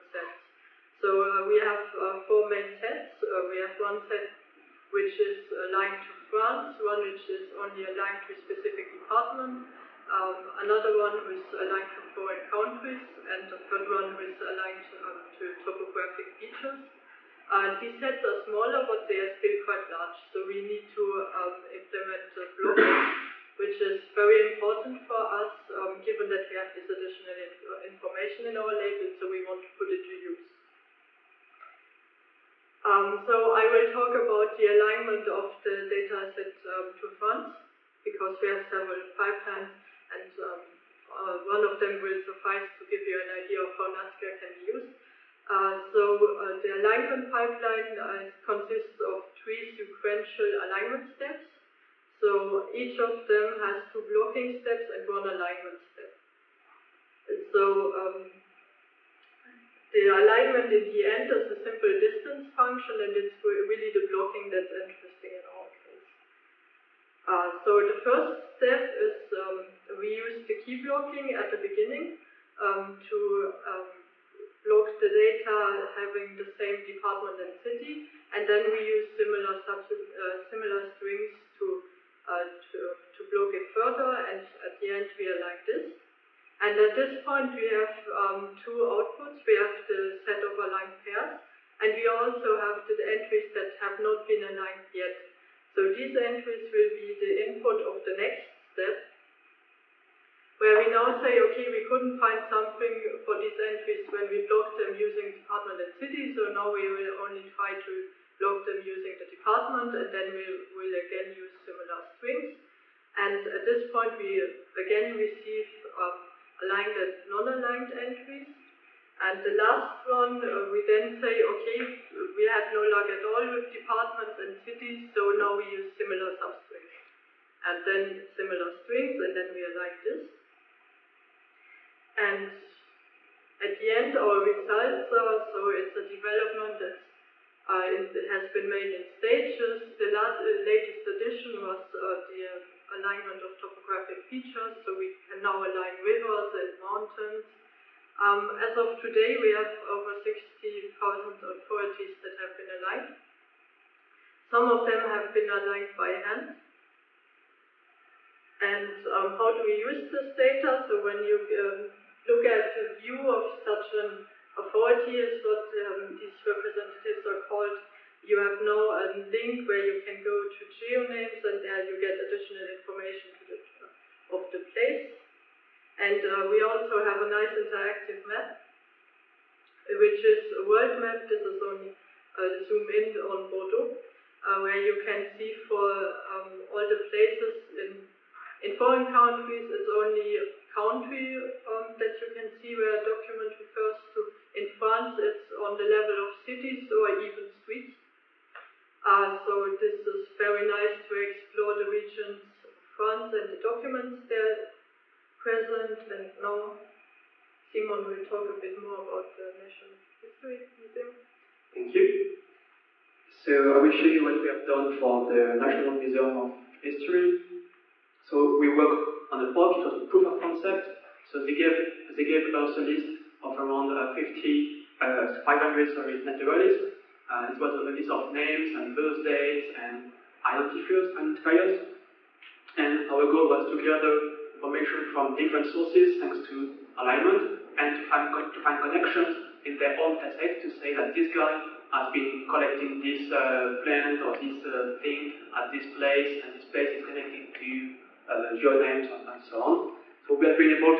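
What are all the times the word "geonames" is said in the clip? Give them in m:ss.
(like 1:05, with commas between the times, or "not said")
2:50, 4:08.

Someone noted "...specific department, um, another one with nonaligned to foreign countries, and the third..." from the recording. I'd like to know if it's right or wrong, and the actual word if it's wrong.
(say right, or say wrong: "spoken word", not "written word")
wrong: "aligned", not "nonaligned".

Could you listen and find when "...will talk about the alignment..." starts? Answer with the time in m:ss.
0:33.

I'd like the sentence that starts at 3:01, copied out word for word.
This is only uh, zoom in on Bordeaux, uh, where you can see for um, all the places in in foreign countries.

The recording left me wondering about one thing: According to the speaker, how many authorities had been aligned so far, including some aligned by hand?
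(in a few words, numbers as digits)
over 60,000.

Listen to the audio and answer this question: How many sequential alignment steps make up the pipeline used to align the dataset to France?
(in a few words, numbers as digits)
3.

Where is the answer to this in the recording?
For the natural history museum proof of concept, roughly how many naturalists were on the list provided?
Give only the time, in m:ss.
3:45.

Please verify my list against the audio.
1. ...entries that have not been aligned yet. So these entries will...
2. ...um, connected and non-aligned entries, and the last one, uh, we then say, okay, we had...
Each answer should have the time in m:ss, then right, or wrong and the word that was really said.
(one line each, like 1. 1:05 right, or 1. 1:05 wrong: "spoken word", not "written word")
1. 1:33 right
2. 1:55 wrong: "aligned", not "connected".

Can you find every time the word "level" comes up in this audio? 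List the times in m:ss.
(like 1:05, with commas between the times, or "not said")
3:15.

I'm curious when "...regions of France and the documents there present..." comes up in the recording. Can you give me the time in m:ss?
3:21.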